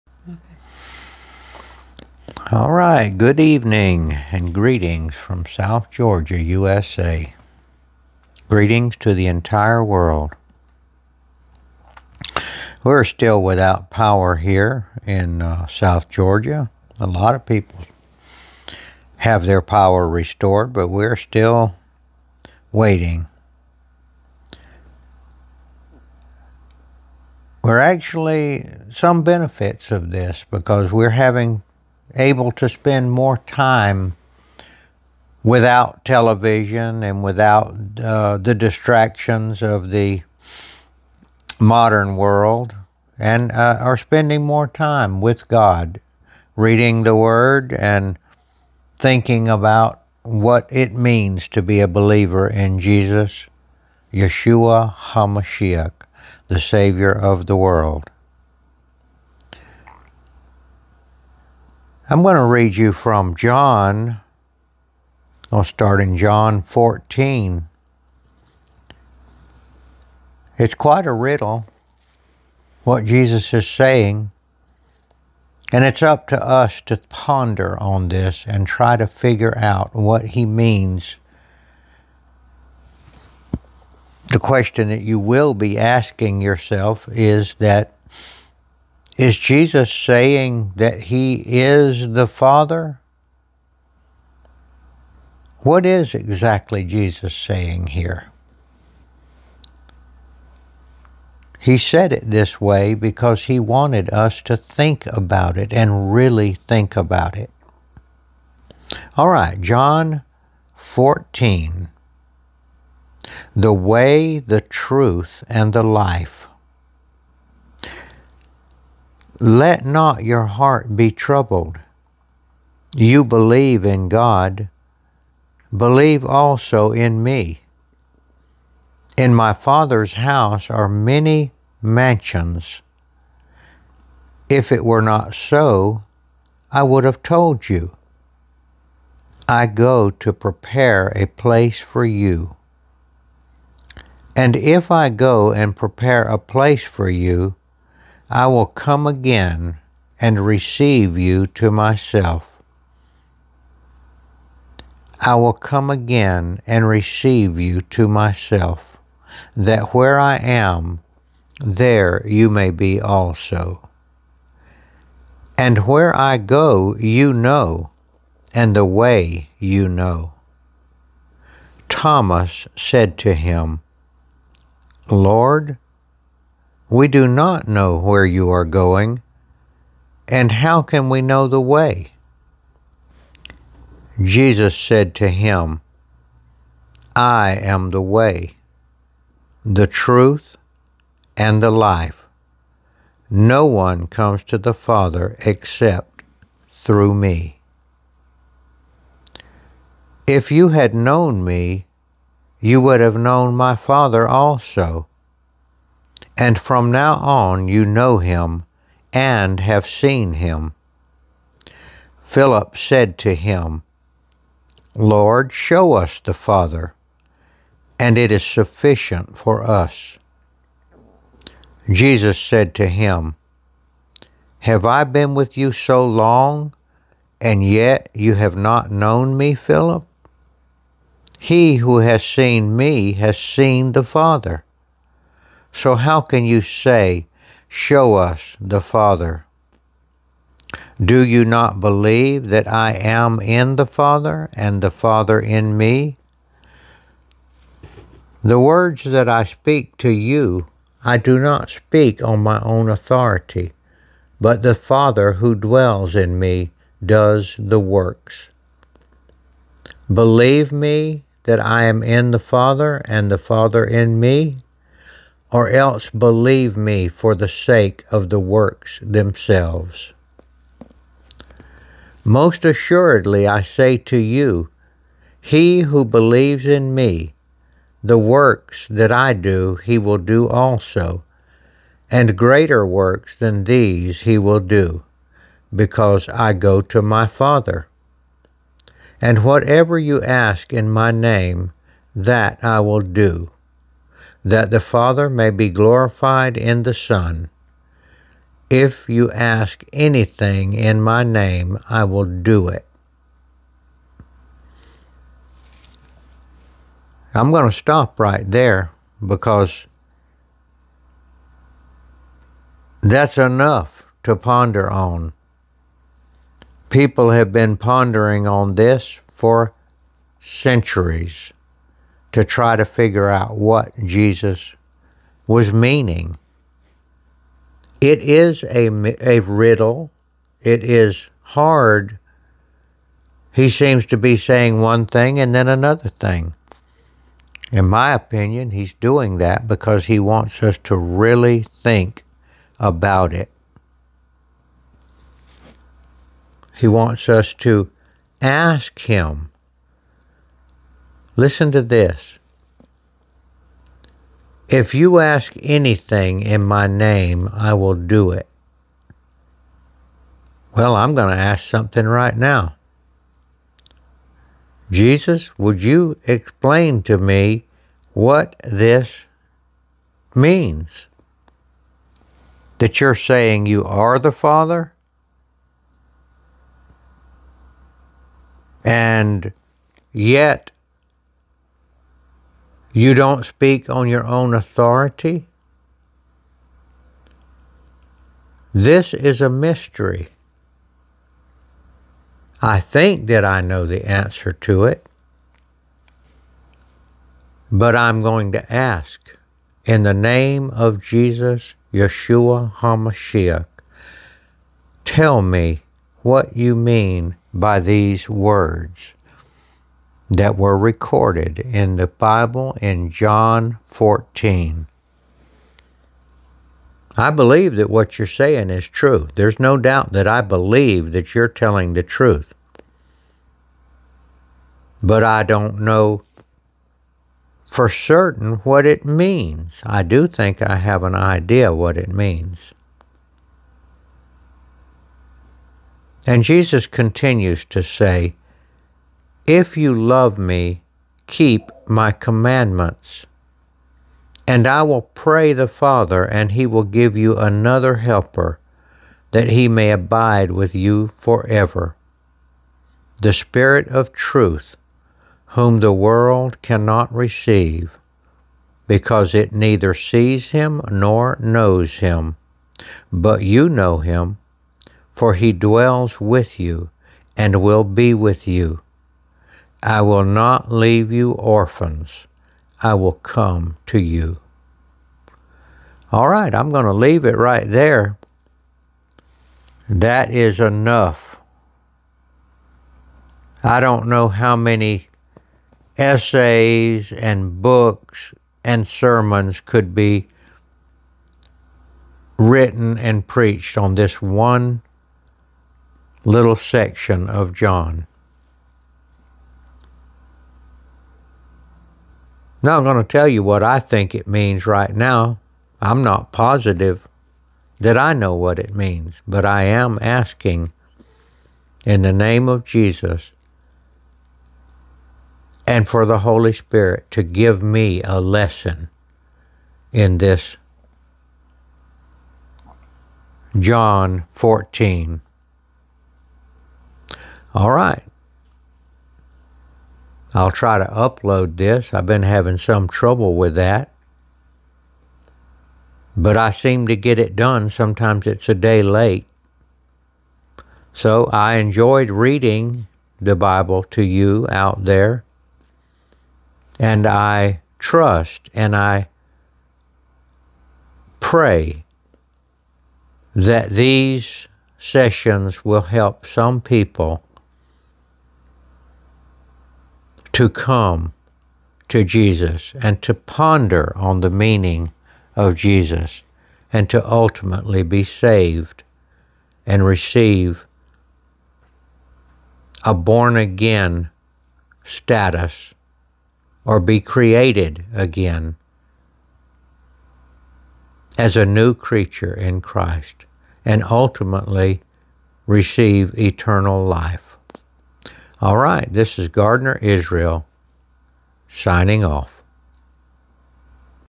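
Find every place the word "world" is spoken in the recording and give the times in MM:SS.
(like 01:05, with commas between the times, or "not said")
00:09, 00:42, 00:57, 07:35.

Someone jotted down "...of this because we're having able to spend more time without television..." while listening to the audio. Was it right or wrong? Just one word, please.
right.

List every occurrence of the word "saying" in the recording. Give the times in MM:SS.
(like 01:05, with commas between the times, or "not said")
01:13, 01:29, 01:37, 05:34, 06:13, 06:58.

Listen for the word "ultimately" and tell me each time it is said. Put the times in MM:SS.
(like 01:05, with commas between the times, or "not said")
09:27, 09:43.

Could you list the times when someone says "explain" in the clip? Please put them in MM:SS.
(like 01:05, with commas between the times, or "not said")
06:06.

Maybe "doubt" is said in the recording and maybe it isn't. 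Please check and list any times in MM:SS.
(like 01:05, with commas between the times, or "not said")
06:59.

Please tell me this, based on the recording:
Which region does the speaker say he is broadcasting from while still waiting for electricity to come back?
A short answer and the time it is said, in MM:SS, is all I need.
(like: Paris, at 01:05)
South Georgia, USA, at 00:05.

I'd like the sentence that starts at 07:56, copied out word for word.
All right, I'm going to leave it right there.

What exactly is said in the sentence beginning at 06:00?
Well, I'm going to ask something right now.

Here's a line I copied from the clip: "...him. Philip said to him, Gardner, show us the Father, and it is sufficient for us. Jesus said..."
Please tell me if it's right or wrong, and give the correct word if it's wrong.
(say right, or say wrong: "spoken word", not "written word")
wrong: "Lord", not "Gardner".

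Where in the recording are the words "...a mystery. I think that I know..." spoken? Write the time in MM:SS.
06:29.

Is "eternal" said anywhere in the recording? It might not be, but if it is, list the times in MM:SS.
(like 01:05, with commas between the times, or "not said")
09:46.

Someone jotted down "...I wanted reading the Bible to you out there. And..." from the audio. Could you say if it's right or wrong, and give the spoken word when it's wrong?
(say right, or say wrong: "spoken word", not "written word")
wrong: "enjoyed", not "wanted".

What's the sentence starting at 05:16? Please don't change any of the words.
People have been pondering on this for centuries to try to figure out what Jesus was meaning.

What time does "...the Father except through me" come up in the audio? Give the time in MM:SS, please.
03:14.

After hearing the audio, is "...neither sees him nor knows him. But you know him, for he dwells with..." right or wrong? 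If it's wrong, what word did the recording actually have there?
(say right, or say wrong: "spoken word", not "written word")
right.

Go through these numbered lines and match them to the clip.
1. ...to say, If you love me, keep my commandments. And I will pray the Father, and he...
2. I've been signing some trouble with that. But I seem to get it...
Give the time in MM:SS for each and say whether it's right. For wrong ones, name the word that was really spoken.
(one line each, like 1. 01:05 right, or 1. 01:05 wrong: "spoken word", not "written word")
1. 07:17 right
2. 08:51 wrong: "having", not "signing".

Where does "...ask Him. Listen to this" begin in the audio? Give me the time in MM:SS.
05:48.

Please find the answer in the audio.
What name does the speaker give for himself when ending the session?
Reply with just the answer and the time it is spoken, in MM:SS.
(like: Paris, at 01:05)
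Gardner Israel, at 09:49.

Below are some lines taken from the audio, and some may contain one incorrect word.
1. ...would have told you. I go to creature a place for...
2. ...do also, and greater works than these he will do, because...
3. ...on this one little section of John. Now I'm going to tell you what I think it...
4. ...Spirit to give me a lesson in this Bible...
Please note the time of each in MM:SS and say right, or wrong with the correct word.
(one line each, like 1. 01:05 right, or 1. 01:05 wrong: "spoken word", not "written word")
1. 02:16 wrong: "prepare", not "creature"
2. 04:40 right
3. 08:13 right
4. 08:36 wrong: "John", not "Bible".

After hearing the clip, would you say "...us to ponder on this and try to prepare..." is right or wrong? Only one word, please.
wrong.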